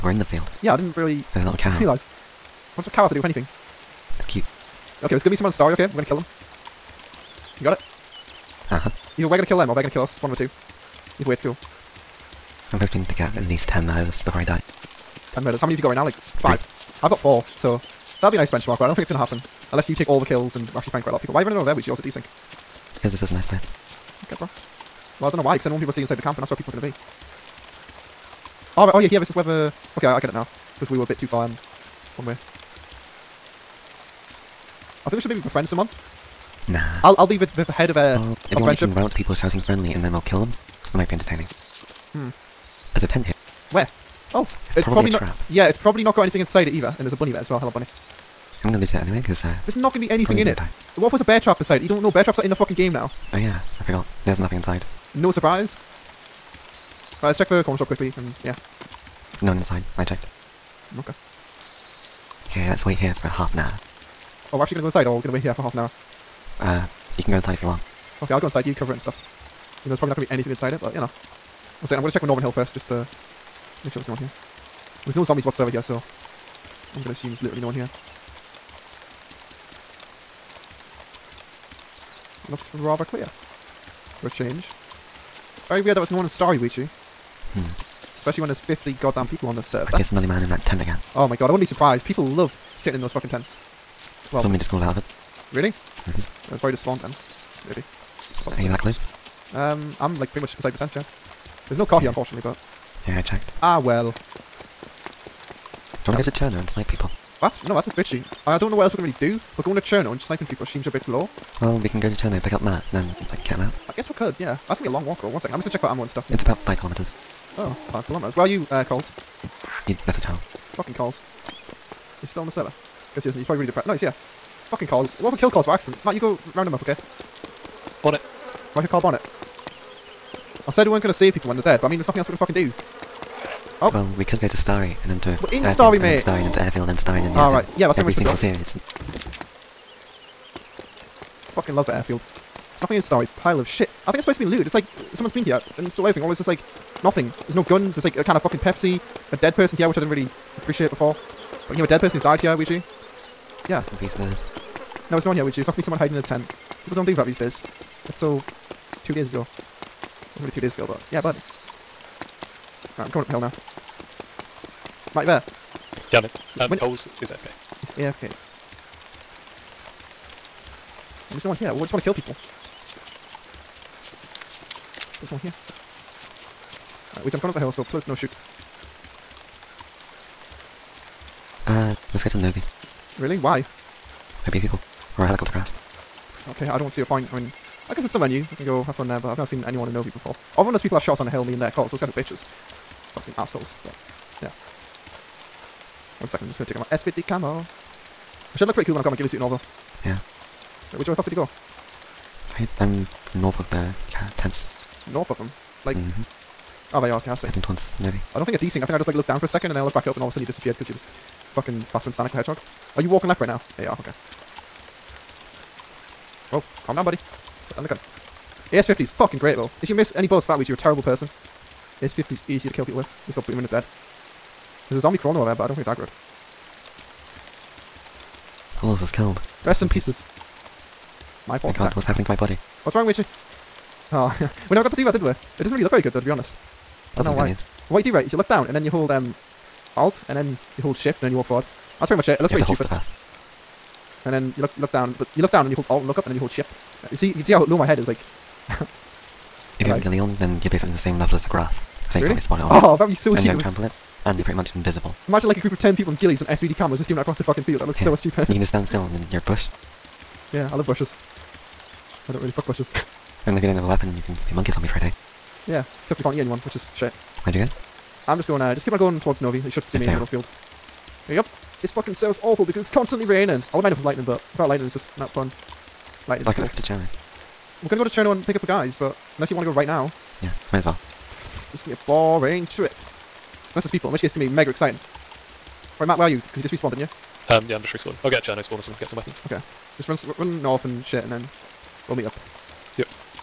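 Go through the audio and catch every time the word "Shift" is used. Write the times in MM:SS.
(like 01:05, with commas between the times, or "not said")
04:00, 04:06.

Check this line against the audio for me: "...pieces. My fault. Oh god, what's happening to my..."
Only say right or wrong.
right.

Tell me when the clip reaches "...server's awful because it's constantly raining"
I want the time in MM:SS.
04:32.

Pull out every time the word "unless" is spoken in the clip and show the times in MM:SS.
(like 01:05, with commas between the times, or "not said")
00:19, 04:39, 04:43.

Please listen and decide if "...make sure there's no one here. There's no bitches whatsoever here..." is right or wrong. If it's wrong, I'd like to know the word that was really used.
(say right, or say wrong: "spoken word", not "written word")
wrong: "zombies", not "bitches".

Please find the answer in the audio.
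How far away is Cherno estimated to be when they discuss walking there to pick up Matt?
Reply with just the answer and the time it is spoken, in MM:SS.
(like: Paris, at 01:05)
5 kilometres, at 01:56.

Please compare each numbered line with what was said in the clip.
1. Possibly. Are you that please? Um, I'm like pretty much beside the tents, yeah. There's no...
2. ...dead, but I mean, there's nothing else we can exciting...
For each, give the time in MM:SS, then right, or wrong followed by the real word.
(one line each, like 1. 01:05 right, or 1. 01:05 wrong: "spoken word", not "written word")
1. 01:38 wrong: "close", not "please"
2. 02:11 wrong: "fucking", not "exciting".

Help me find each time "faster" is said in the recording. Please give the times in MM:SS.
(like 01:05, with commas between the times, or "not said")
03:31.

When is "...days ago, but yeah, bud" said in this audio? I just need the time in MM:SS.
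02:40.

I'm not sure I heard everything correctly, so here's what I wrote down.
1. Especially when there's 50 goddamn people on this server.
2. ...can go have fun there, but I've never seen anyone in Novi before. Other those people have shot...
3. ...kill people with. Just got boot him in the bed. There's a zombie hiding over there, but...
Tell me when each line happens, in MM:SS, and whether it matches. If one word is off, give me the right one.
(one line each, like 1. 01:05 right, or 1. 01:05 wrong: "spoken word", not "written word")
1. 01:28 right
2. 03:08 right
3. 03:42 wrong: "crawling", not "hiding".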